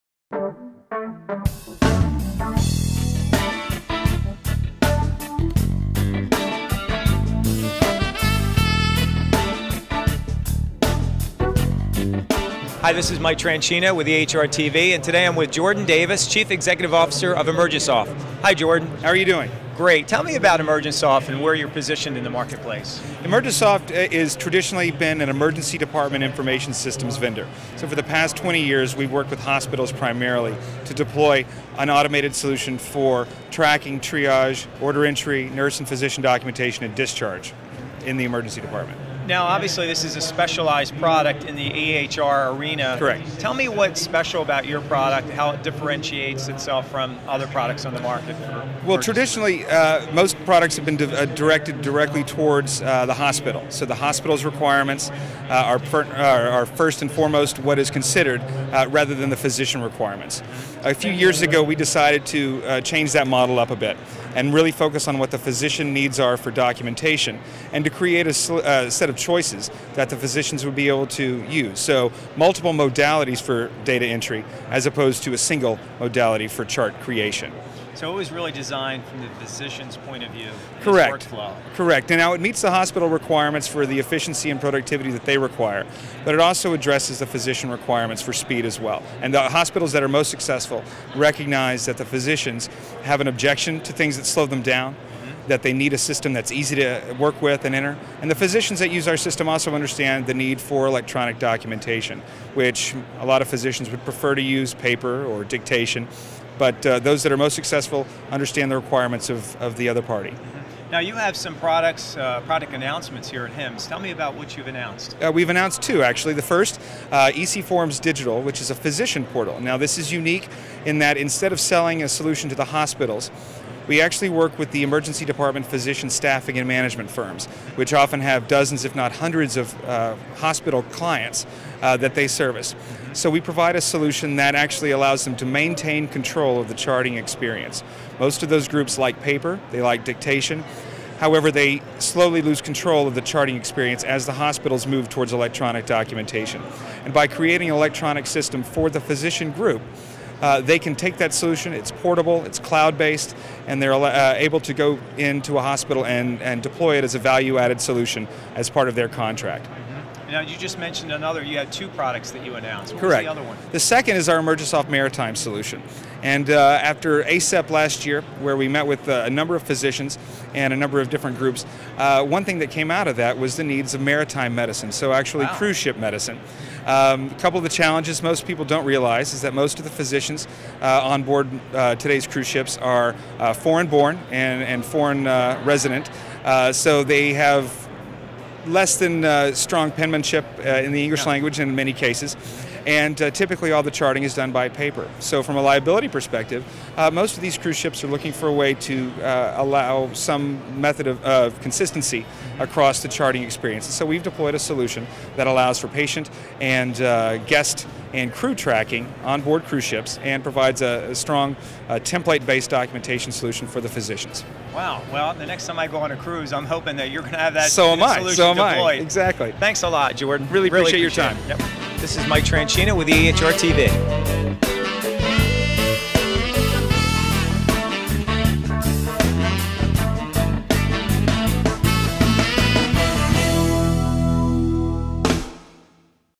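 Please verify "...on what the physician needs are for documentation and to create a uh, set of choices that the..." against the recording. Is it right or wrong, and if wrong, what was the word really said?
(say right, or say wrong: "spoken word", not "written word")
right.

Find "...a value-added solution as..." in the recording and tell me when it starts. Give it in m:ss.
2:37.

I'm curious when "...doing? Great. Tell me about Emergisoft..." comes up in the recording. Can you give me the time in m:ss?
0:19.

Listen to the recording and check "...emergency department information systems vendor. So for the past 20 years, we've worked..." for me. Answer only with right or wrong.
right.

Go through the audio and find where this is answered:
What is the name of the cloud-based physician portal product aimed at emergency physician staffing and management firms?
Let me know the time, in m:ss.
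1:57.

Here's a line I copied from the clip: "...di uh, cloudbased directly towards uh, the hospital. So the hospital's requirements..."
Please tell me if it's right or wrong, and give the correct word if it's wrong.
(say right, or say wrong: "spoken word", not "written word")
wrong: "directed", not "cloudbased".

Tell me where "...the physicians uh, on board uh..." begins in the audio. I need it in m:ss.
2:59.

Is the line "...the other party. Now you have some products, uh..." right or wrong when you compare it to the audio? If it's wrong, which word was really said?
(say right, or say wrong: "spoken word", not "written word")
right.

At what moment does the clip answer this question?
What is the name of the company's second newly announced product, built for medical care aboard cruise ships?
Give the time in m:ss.
2:44.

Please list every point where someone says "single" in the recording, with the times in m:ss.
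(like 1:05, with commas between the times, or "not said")
1:15.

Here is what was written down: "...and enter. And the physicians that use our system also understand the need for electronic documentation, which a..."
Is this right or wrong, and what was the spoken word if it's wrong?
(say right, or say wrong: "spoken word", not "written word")
right.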